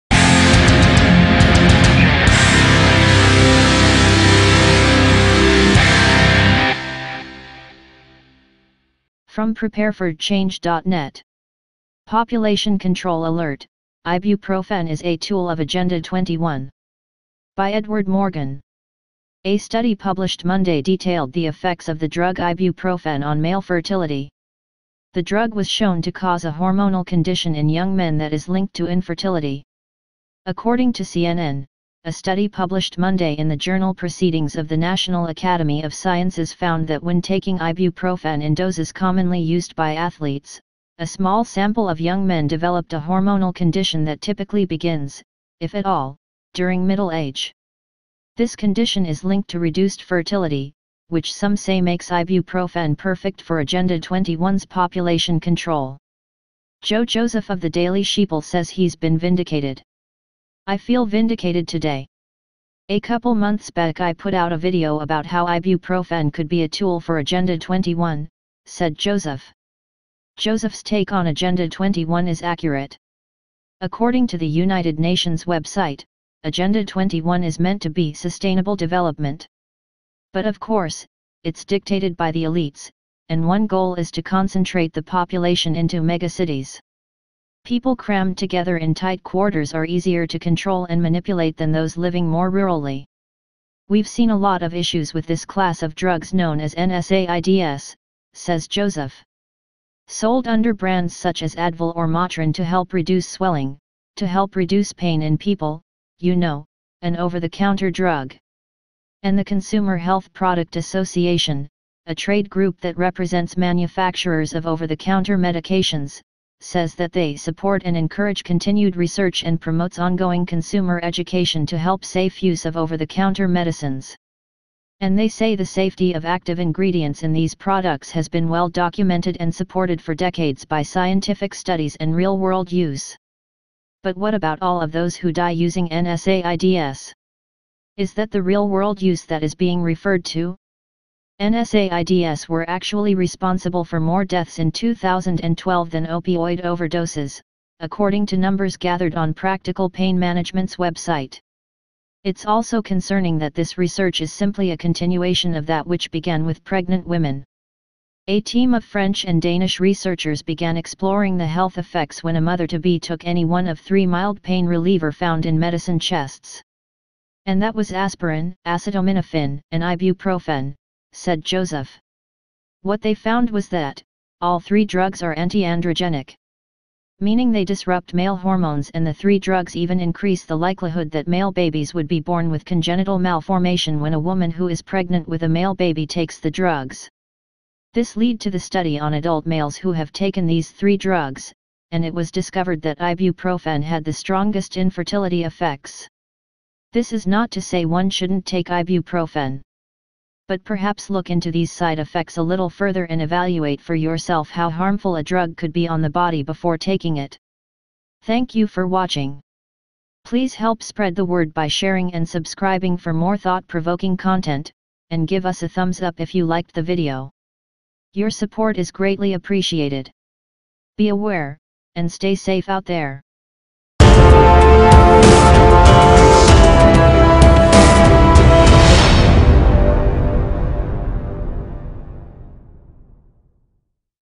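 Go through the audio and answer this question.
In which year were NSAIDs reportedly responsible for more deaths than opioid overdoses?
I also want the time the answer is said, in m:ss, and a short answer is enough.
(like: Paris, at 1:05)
2012, at 2:24.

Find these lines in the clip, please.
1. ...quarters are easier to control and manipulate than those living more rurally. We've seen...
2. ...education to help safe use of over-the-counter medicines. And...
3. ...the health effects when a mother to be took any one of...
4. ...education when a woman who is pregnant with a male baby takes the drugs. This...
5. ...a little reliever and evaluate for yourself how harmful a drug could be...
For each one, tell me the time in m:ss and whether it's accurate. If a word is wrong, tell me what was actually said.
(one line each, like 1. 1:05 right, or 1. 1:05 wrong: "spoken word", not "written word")
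1. 1:29 right
2. 2:01 right
3. 2:41 right
4. 3:03 wrong: "malformation", not "education"
5. 3:22 wrong: "further", not "reliever".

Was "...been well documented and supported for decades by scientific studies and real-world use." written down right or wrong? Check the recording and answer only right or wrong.
right.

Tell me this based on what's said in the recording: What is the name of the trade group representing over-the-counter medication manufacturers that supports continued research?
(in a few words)
Consumer Health Product Association.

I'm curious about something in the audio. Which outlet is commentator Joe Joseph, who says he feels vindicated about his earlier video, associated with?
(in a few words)
Daily Sheeple.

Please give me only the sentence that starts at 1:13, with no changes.
According to the United Nations website, Agenda 21 is meant to be sustainable development.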